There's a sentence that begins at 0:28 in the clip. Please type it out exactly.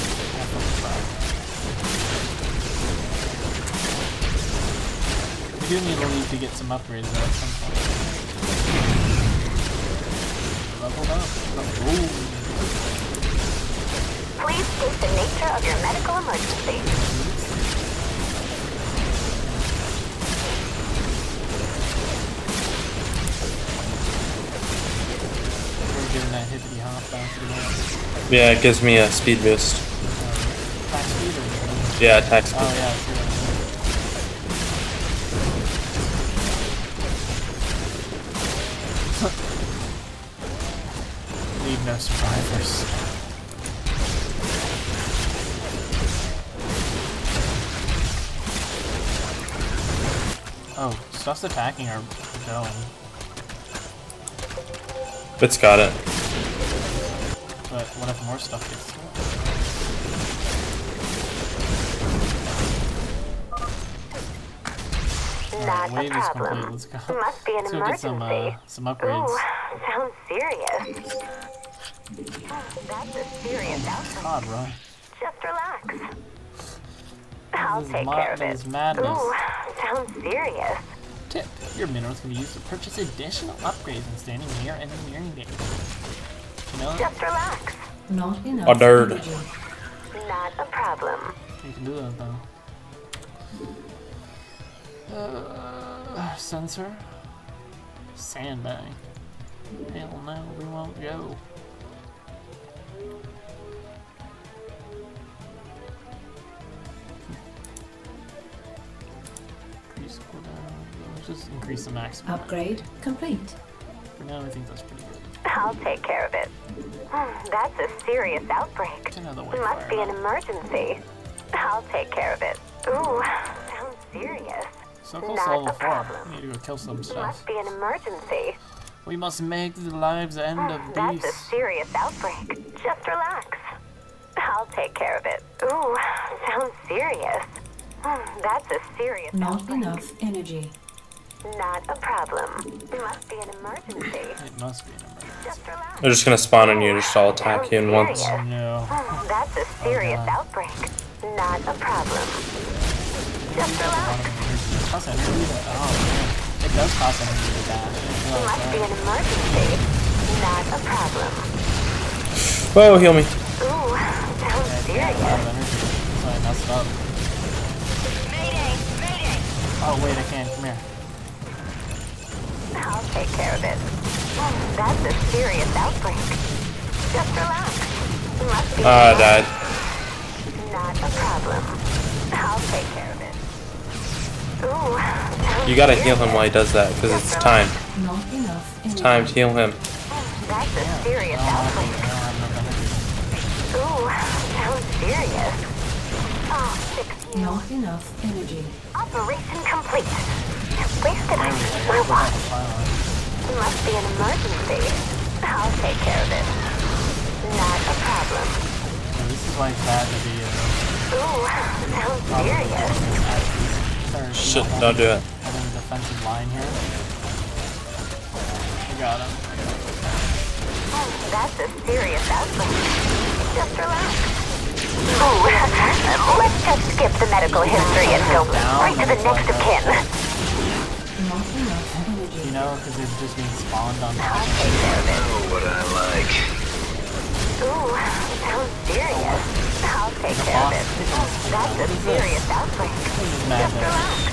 Yeah, it gives me a speed boost.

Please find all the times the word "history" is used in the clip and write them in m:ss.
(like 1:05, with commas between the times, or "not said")
3:47.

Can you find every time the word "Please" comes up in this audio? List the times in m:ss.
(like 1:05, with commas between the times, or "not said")
0:14, 3:20.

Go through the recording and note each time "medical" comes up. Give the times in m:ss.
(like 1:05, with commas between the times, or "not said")
0:15, 3:47.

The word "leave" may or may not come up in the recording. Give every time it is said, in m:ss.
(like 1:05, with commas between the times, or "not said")
0:06.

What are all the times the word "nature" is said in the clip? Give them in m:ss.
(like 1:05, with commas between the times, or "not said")
0:15.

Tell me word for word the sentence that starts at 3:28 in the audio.
Yeah, this is like bad video.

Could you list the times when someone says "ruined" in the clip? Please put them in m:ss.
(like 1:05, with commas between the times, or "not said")
not said.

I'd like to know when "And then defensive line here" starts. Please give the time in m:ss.
3:35.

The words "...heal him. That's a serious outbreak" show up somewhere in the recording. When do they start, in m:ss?
3:09.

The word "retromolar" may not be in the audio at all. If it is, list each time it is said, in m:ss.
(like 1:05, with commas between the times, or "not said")
not said.